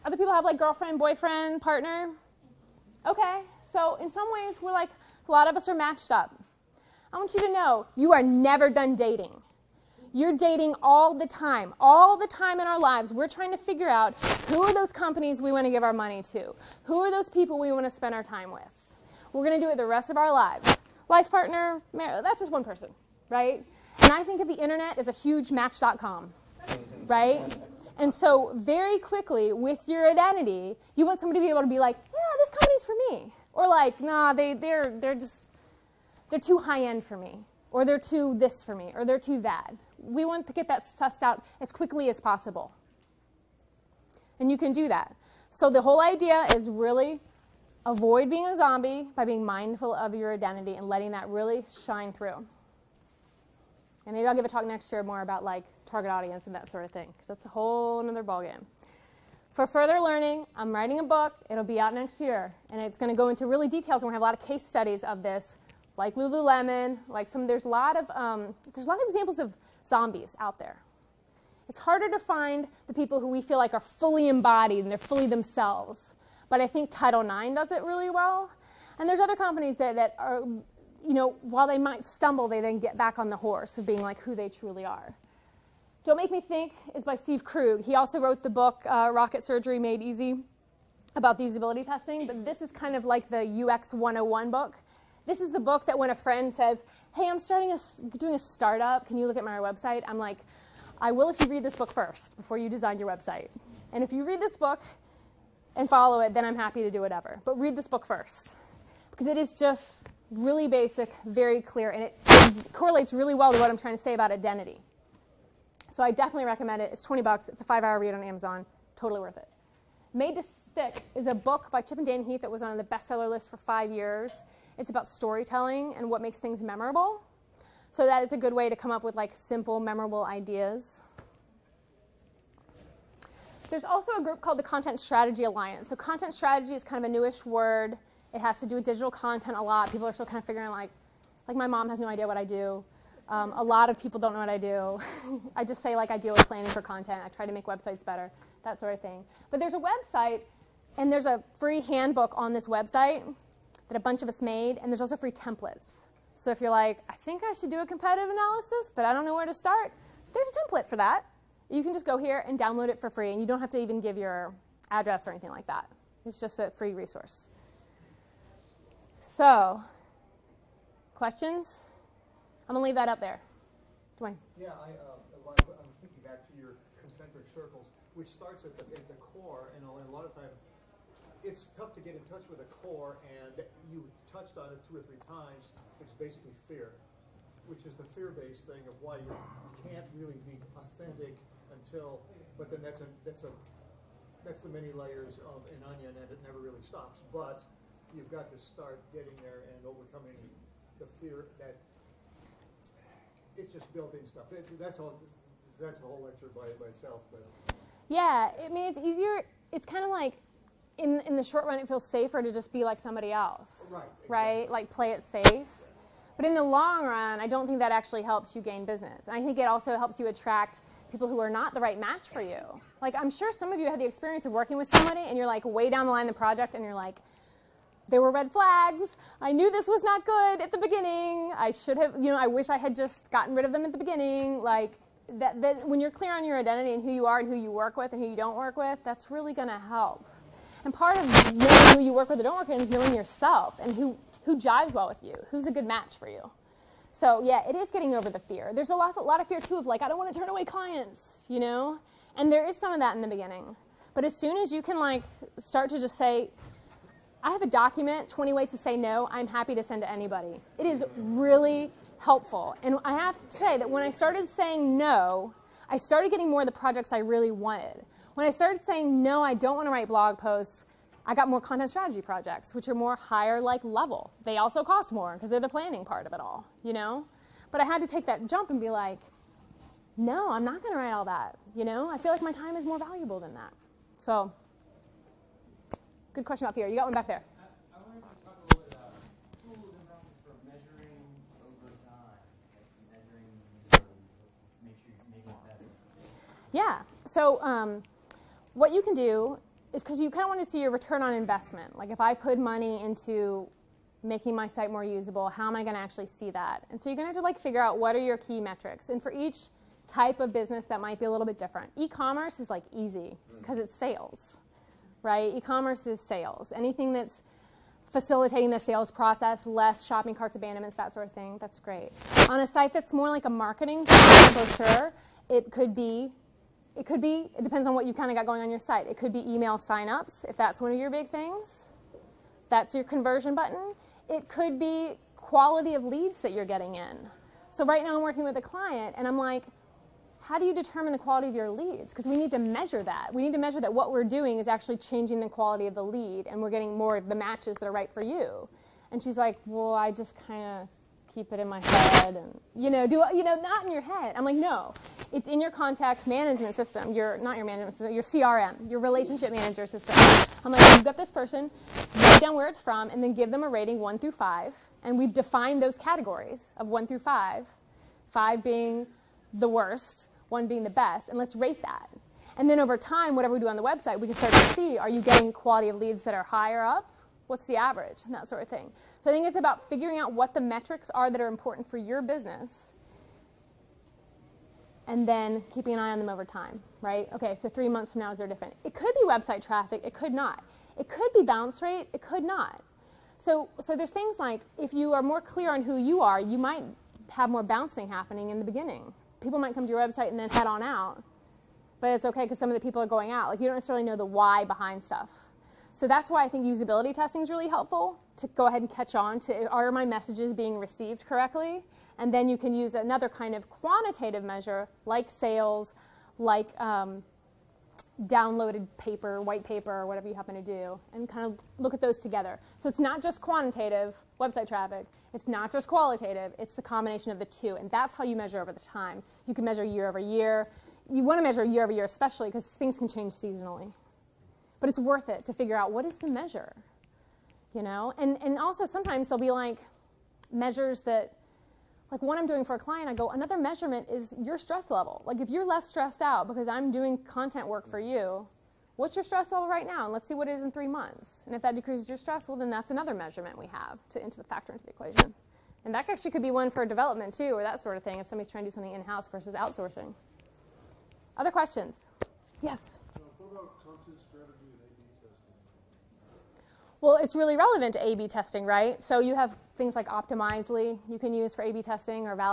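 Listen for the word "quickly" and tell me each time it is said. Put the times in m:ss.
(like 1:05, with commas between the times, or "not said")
0:28, 0:41.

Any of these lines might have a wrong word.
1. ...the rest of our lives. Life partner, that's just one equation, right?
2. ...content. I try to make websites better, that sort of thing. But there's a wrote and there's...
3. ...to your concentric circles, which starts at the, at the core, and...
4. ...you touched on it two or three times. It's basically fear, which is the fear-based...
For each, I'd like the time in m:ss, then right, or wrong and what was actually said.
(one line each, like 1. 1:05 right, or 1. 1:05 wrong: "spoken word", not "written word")
1. 0:19 wrong: "person", not "equation"
2. 2:26 wrong: "website", not "wrote"
3. 2:56 right
4. 3:03 right.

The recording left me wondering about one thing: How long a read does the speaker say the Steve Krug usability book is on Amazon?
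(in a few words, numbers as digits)
5 hours.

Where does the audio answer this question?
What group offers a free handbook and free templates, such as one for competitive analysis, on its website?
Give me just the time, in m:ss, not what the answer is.
2:14.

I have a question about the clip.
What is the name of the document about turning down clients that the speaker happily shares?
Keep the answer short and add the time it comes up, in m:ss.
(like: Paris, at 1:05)
20 ways to say no, at 4:18.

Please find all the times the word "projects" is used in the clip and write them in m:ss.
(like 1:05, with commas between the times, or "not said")
3:46, 4:26, 4:32.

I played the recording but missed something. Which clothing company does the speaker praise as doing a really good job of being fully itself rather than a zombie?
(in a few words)
Title Nine.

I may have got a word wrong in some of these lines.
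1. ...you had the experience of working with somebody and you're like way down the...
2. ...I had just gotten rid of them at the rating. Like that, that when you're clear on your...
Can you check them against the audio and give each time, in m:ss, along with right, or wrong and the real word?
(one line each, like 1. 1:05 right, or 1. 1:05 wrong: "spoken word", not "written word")
1. 3:43 right
2. 3:52 wrong: "beginning", not "rating".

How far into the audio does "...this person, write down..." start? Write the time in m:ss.
6:01.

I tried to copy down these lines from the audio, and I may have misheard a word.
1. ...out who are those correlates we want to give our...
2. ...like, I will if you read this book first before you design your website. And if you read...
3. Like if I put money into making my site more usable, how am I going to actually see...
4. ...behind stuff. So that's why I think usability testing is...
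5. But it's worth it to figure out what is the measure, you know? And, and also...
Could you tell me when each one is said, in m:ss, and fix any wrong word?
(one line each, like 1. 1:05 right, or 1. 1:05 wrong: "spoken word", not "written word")
1. 0:13 wrong: "companies", not "correlates"
2. 1:40 right
3. 5:01 right
4. 6:44 right
5. 7:14 right.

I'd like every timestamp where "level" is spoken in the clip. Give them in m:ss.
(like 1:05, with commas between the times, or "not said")
4:33, 7:24, 7:29.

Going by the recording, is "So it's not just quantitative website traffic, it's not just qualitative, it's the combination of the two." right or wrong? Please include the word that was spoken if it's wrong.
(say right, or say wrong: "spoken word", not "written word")
right.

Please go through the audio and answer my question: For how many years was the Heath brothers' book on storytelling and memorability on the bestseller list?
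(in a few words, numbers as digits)
5 years.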